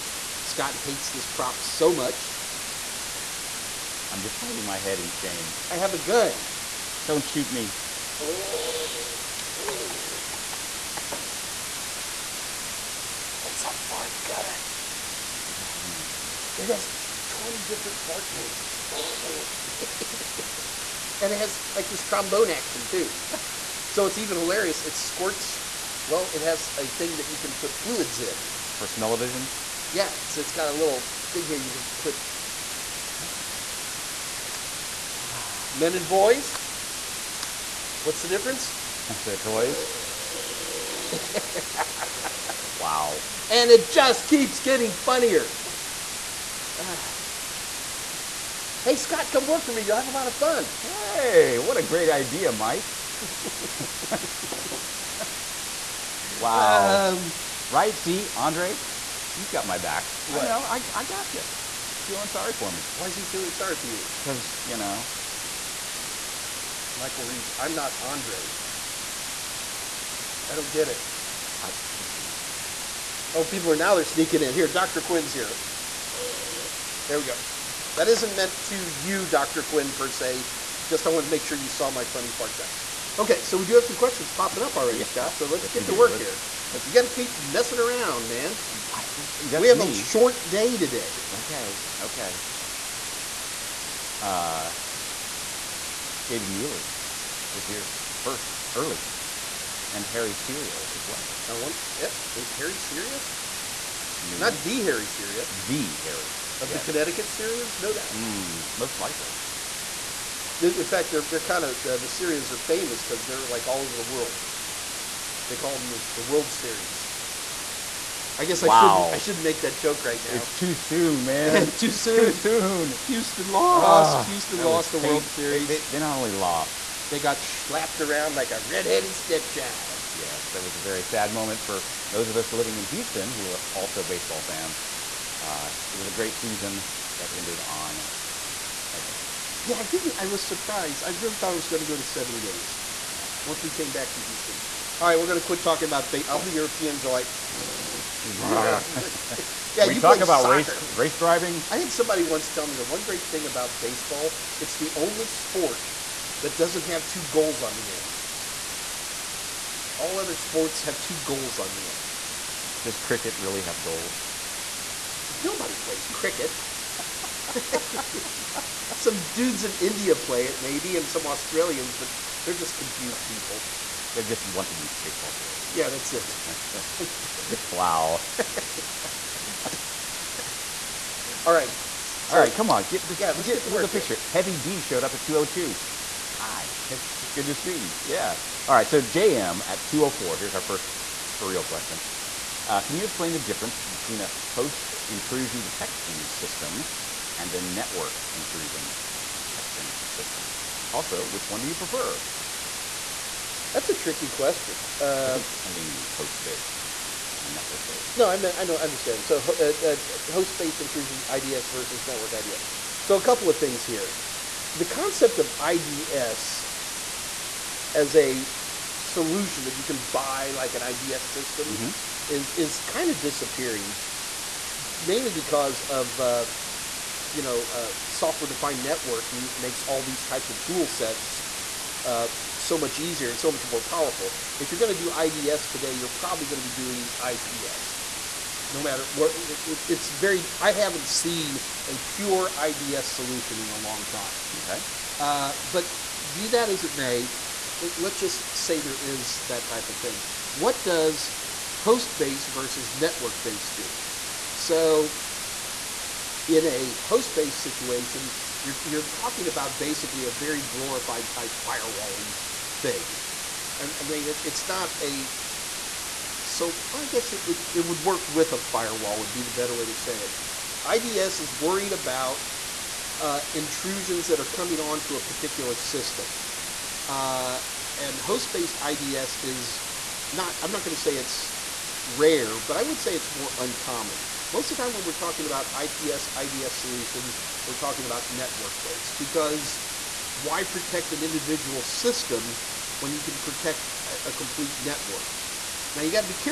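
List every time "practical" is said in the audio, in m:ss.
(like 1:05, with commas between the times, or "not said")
not said.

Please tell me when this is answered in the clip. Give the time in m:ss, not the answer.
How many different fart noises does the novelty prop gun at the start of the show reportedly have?
0:17.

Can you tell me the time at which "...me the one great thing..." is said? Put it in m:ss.
2:32.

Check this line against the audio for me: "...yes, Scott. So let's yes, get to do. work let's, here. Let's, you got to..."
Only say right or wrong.
right.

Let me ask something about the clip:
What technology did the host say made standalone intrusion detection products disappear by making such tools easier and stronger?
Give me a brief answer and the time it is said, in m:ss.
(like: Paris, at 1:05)
Software-defined networking, at 3:48.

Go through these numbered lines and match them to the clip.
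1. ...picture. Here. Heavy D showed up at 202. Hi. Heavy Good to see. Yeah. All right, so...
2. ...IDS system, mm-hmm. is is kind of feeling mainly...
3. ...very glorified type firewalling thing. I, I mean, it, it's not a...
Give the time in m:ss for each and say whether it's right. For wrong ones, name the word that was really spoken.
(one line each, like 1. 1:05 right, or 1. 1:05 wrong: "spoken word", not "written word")
1. 3:03 right
2. 3:40 wrong: "disappearing", not "feeling"
3. 4:20 right.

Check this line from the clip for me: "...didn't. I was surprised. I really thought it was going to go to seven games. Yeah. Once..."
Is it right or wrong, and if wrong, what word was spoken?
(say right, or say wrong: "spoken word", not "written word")
right.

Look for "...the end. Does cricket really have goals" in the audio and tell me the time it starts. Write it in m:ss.
2:41.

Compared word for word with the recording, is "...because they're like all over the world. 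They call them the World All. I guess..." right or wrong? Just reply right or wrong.
wrong.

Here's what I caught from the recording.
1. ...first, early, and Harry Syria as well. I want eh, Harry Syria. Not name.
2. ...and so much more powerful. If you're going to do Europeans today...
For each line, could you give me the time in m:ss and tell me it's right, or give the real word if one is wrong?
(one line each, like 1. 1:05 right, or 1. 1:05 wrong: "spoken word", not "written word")
1. 1:38 right
2. 3:53 wrong: "IDS", not "Europeans".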